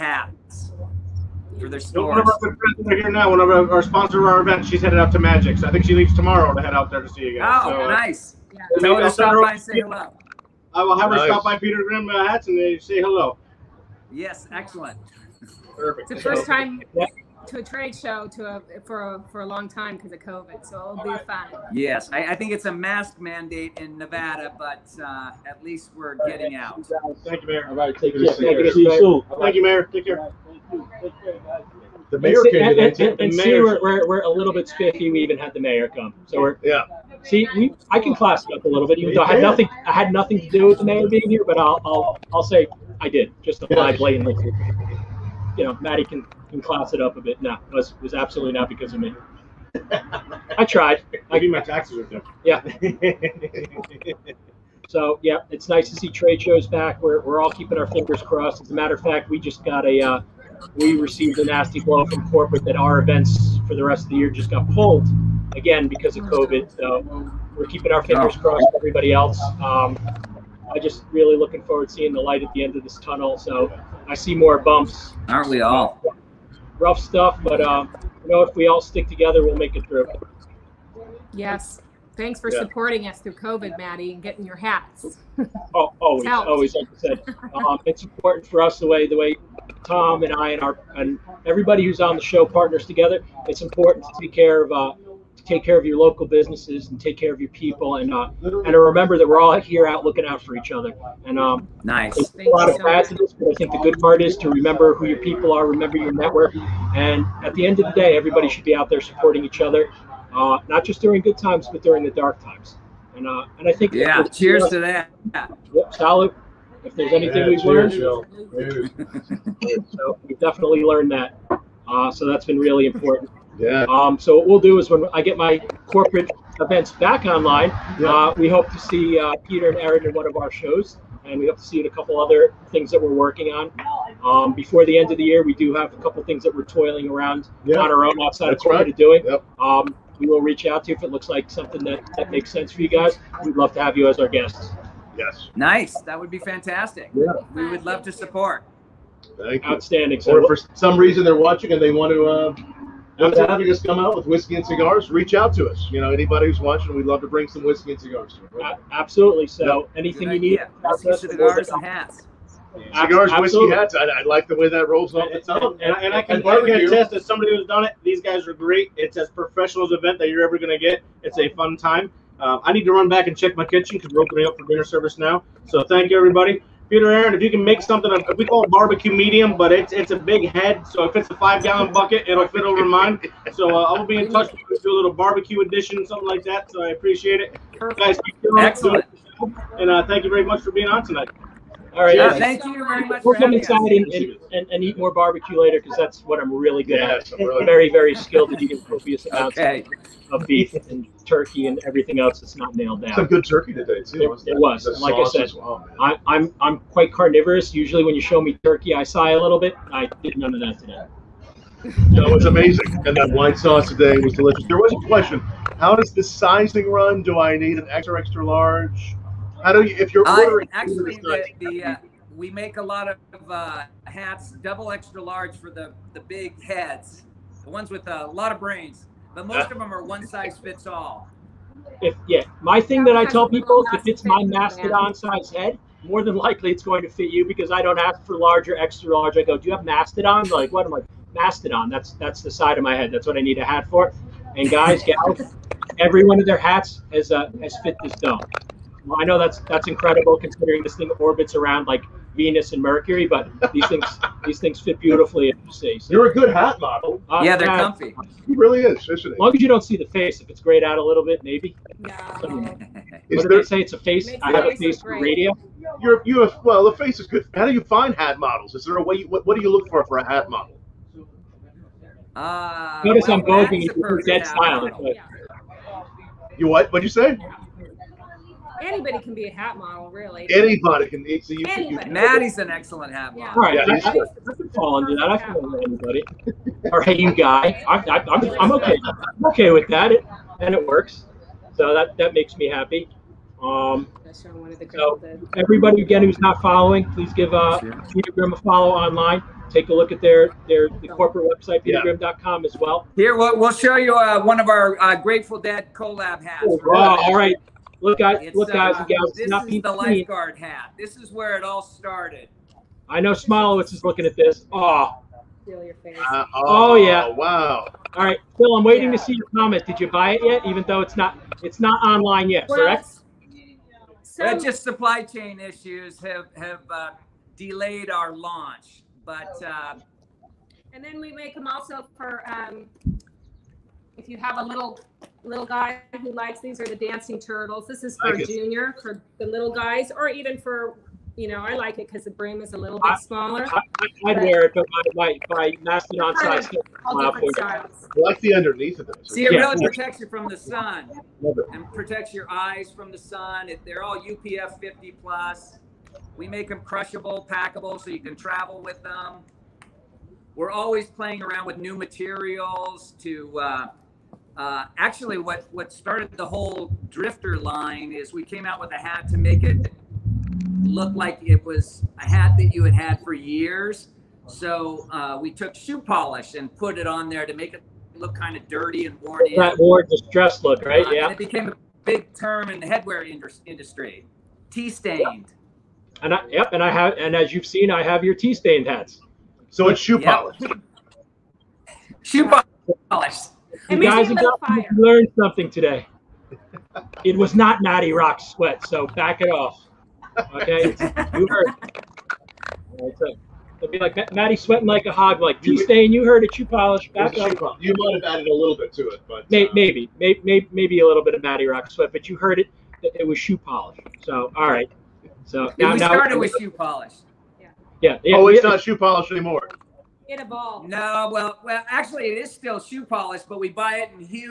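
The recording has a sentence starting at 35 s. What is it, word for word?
We even had the mayor come, so we're yeah.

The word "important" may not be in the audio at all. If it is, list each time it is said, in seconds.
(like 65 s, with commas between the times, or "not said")
88 s, 93 s, 122 s.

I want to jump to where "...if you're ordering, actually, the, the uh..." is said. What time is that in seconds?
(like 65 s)
219 s.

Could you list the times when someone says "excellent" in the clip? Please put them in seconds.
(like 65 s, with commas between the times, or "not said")
14 s, 188 s, 282 s.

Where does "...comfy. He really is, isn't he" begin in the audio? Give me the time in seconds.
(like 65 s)
257 s.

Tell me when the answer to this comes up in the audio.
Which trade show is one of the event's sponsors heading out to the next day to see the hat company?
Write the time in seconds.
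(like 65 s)
5 s.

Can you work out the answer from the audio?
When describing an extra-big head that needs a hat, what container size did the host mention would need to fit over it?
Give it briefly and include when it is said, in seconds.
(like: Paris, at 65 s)
5-gallon bucket, at 181 s.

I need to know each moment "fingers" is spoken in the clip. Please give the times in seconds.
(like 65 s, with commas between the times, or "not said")
57 s, 68 s.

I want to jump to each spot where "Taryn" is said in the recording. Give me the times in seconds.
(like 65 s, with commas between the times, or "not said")
not said.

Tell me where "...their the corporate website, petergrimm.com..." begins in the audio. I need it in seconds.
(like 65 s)
300 s.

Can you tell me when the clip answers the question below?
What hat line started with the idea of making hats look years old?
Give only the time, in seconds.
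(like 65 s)
367 s.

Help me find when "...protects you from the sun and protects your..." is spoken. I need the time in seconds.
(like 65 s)
349 s.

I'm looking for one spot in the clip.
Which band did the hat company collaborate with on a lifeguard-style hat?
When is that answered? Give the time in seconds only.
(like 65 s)
305 s.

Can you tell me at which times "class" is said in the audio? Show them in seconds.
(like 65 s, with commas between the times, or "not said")
38 s, 46 s.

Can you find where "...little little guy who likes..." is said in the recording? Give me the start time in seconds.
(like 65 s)
334 s.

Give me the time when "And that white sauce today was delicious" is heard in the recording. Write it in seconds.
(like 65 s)
213 s.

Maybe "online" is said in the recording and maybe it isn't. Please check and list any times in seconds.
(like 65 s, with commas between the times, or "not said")
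127 s, 298 s, 322 s.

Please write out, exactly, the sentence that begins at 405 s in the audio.
Like you stain, you heard it.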